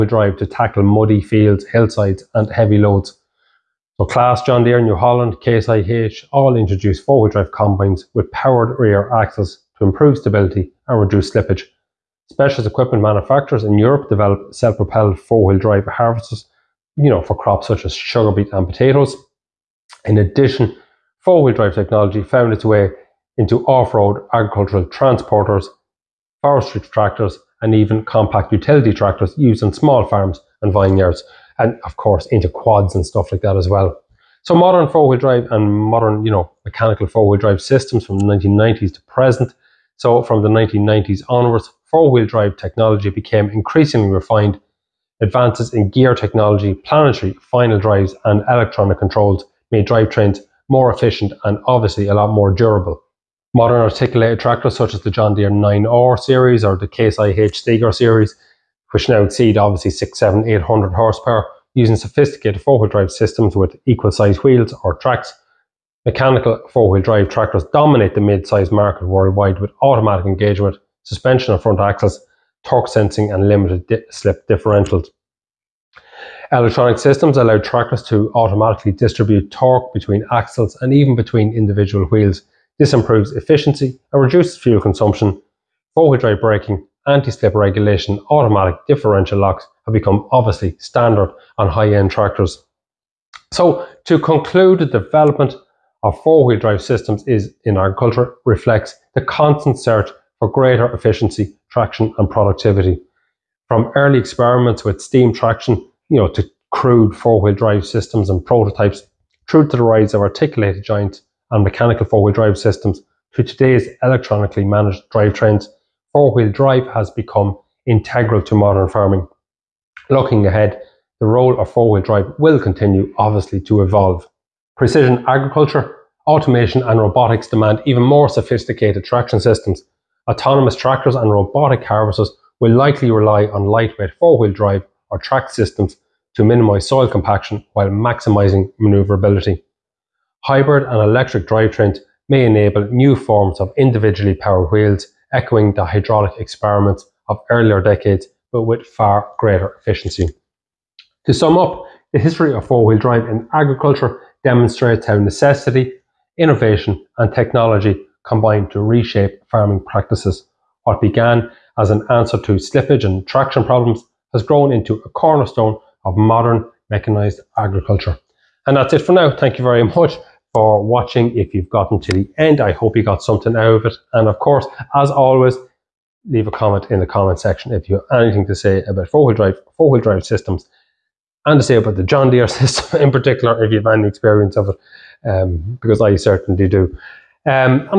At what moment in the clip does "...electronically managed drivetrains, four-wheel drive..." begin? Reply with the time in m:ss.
1:54.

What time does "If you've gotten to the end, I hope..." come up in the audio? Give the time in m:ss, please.
2:51.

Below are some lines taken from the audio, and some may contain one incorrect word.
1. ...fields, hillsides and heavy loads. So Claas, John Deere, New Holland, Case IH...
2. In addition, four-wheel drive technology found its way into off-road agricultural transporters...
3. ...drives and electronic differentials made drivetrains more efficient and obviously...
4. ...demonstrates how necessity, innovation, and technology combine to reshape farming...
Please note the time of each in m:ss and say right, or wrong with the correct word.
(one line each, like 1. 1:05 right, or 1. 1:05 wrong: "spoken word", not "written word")
1. 0:01 right
2. 0:20 right
3. 0:47 wrong: "controls", not "differentials"
4. 2:34 right.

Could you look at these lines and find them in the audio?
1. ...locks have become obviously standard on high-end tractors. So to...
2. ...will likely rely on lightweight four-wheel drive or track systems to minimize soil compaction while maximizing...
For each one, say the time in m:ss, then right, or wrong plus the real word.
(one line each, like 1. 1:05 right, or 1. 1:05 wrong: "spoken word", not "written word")
1. 1:29 right
2. 2:12 right.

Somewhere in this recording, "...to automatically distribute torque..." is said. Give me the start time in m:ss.
1:18.